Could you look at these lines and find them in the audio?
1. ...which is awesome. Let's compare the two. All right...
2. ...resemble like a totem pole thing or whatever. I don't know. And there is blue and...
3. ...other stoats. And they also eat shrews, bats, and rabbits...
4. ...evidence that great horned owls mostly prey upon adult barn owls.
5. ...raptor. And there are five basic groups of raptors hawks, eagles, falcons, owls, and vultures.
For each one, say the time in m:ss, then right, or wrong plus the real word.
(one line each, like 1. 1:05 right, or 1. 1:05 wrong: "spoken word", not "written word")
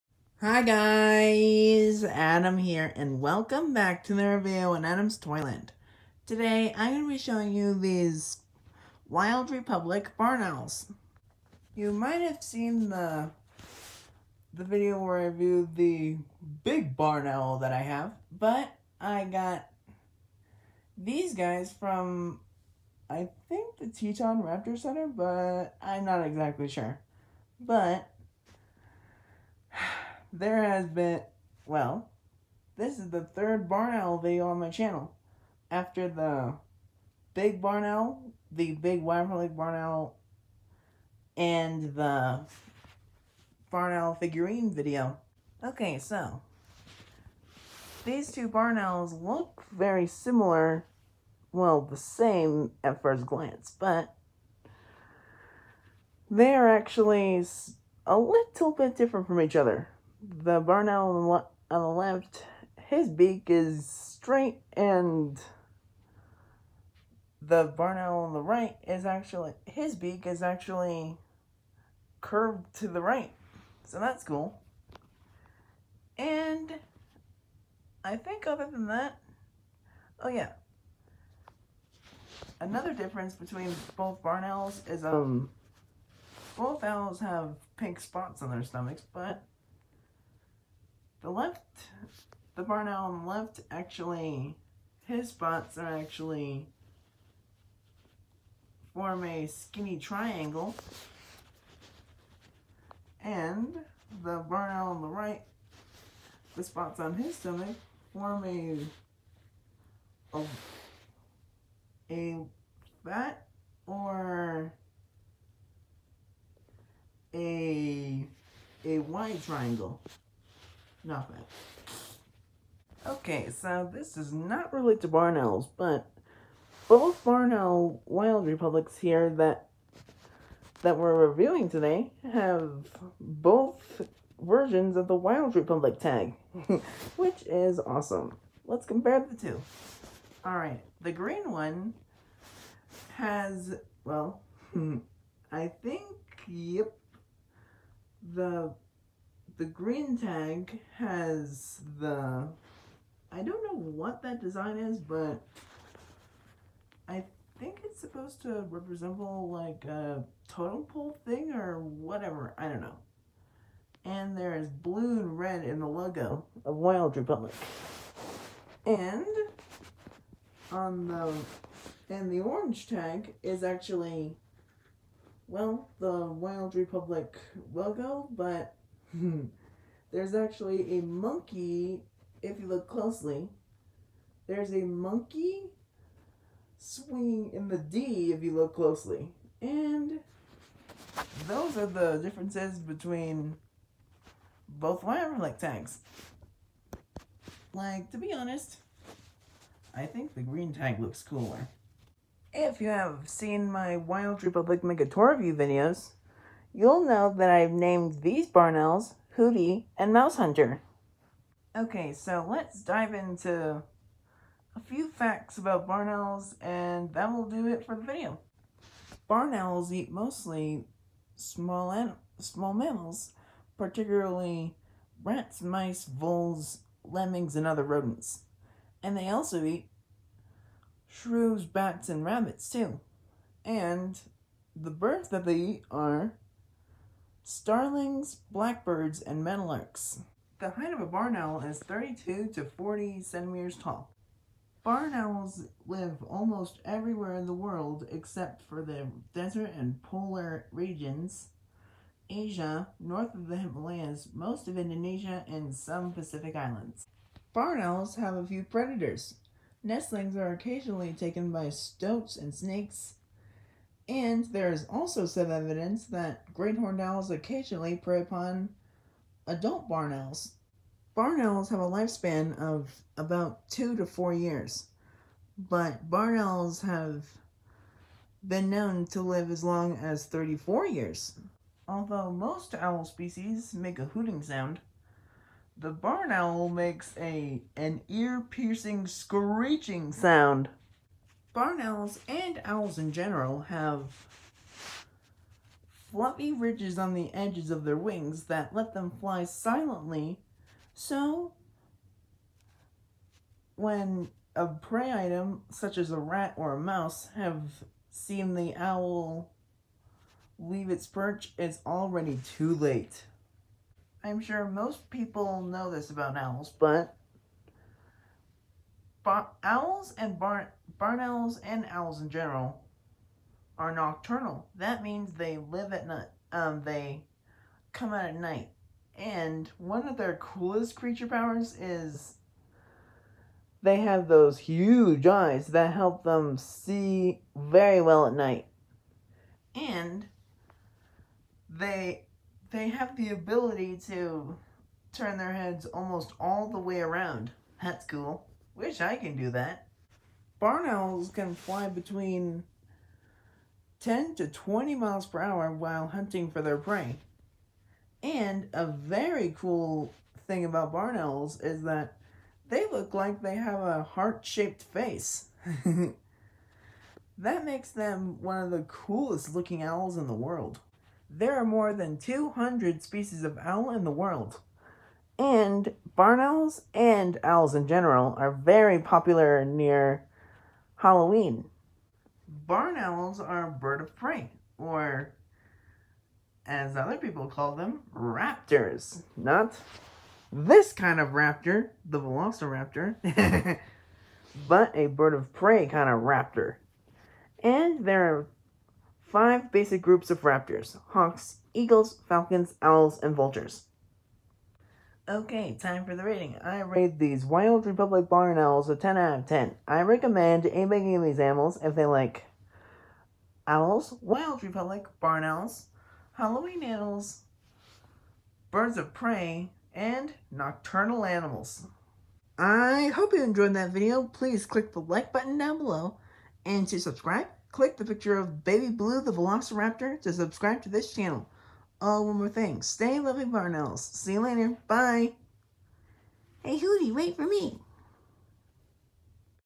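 1. 2:17 right
2. 2:38 right
3. 3:47 wrong: "rodents", not "stoats"
4. 4:25 wrong: "occasionally", not "mostly"
5. 6:36 right.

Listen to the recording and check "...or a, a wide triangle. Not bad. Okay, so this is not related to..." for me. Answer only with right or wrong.
right.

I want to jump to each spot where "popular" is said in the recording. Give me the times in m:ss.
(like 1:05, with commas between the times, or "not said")
6:18.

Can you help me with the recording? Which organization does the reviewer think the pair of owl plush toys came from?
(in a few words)
Teton Raptor Center.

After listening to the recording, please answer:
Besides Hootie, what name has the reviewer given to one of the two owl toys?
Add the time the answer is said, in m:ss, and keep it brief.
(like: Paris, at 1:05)
Mouse Hunter, at 3:30.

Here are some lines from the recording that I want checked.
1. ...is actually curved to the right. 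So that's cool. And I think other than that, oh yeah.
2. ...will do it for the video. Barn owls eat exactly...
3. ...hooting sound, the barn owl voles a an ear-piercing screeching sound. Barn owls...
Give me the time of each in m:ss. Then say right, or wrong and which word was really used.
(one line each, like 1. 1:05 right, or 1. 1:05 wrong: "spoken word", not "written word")
1. 1:10 right
2. 3:37 wrong: "mostly", not "exactly"
3. 4:44 wrong: "makes", not "voles".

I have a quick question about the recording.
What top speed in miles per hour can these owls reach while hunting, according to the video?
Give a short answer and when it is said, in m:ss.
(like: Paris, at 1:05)
20, at 5:54.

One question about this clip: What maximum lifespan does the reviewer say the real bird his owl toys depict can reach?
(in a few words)
34 years.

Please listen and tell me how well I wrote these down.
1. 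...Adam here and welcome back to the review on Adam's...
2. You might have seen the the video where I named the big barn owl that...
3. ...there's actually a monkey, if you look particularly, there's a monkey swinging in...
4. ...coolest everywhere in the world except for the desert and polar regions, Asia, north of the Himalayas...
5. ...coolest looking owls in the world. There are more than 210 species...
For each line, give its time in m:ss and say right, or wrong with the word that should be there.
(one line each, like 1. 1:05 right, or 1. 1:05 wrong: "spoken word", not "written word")
1. 0:02 right
2. 0:11 wrong: "reviewed", not "named"
3. 3:00 wrong: "closely", not "particularly"
4. 4:06 wrong: "almost", not "coolest"
5. 6:08 wrong: "200", not "210".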